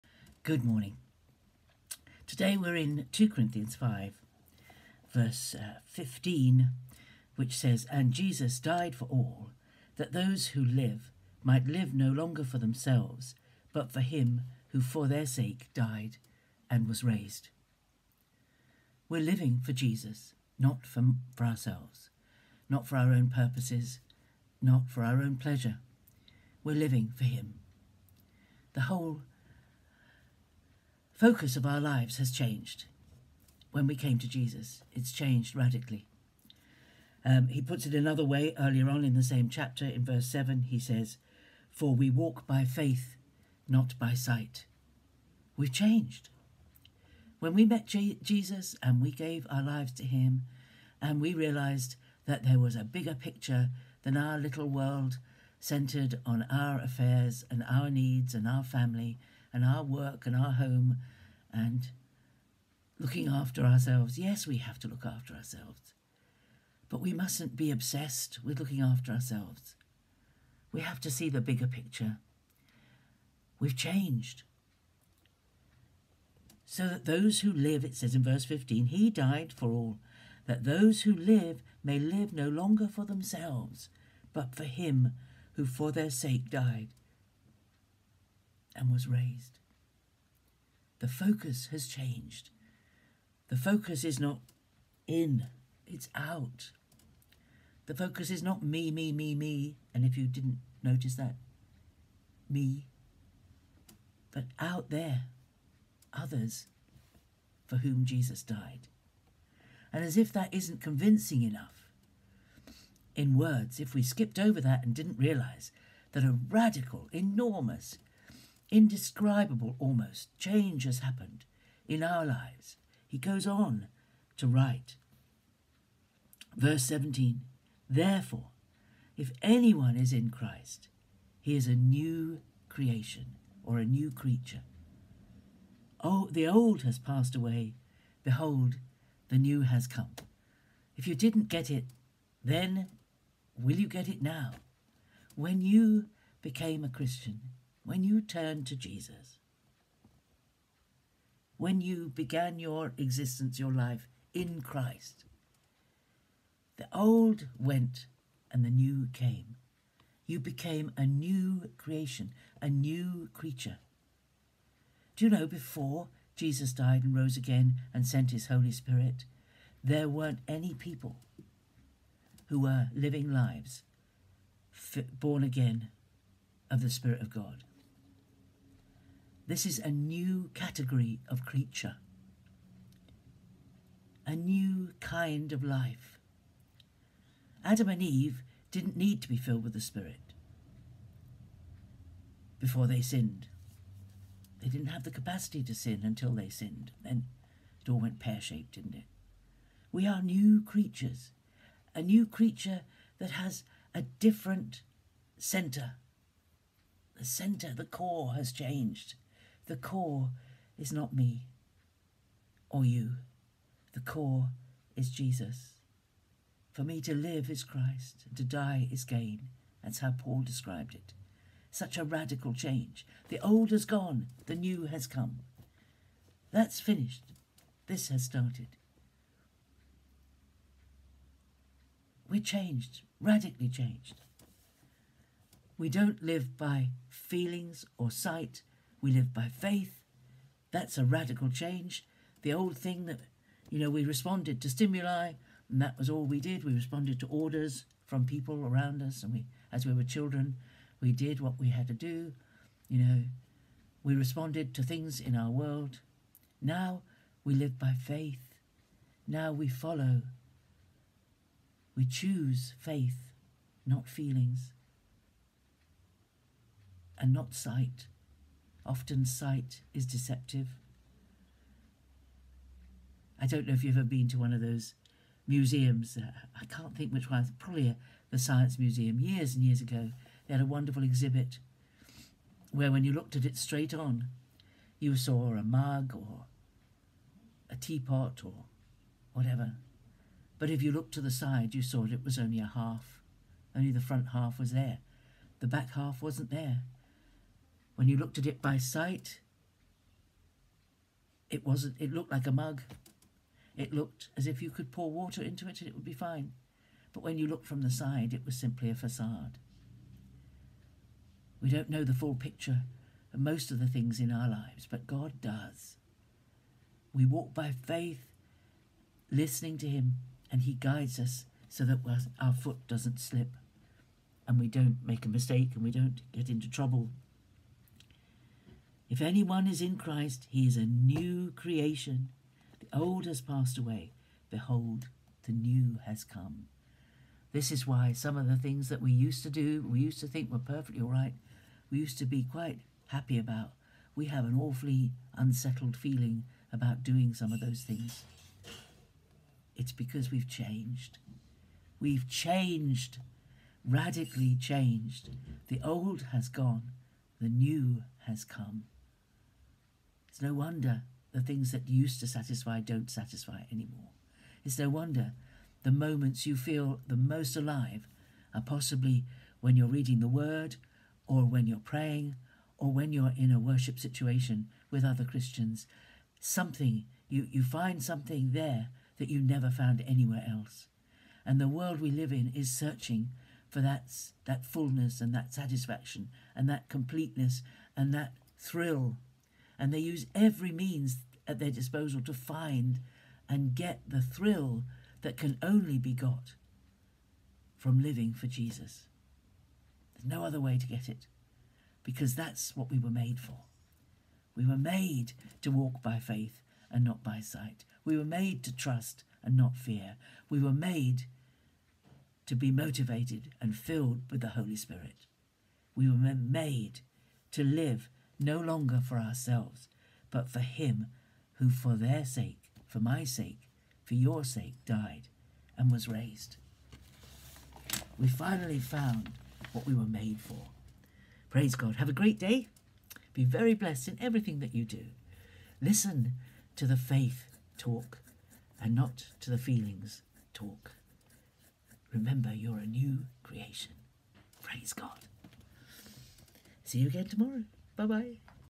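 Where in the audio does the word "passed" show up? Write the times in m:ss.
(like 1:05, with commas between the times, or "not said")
2:16, 5:33.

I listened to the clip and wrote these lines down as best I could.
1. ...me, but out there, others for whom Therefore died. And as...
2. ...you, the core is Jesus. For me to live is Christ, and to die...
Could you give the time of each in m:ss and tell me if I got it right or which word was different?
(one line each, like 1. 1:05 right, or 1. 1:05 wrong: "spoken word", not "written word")
1. 1:42 wrong: "Jesus", not "Therefore"
2. 3:32 right.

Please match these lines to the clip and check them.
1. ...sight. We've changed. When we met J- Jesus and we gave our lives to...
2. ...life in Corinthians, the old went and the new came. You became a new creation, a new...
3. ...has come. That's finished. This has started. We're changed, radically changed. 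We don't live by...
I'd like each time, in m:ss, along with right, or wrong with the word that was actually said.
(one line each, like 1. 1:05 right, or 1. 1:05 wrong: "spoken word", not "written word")
1. 0:44 right
2. 2:33 wrong: "Christ", not "Corinthians"
3. 3:44 right.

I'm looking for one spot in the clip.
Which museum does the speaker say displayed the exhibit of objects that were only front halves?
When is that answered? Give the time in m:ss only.
4:38.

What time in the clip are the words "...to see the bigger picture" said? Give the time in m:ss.
1:11.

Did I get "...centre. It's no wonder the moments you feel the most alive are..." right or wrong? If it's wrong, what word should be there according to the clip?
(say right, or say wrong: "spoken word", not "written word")
wrong: "anymore", not "centre".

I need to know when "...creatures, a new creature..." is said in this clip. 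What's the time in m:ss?
3:20.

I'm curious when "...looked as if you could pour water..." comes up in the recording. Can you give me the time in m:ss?
5:03.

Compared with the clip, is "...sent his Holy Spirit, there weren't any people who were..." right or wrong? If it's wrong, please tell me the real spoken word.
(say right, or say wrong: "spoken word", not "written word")
right.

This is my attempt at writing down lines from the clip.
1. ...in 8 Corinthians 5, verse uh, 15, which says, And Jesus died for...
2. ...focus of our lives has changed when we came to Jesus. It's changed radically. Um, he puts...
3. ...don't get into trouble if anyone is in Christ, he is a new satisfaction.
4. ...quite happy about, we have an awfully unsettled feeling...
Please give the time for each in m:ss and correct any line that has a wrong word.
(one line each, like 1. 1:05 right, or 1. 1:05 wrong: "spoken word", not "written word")
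1. 0:02 wrong: "2", not "8"
2. 0:31 right
3. 5:25 wrong: "creation", not "satisfaction"
4. 5:42 right.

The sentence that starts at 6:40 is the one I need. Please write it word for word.
There's no other way to get it because that's what we were made for.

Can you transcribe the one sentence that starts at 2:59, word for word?
This is a new category of creature, a new kind of life.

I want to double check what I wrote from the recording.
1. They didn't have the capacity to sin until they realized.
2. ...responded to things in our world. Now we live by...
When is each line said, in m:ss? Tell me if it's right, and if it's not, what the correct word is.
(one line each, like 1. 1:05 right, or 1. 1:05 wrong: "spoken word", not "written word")
1. 3:14 wrong: "sinned", not "realized"
2. 4:14 right.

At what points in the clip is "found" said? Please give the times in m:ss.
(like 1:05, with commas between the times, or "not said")
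6:19, 7:08.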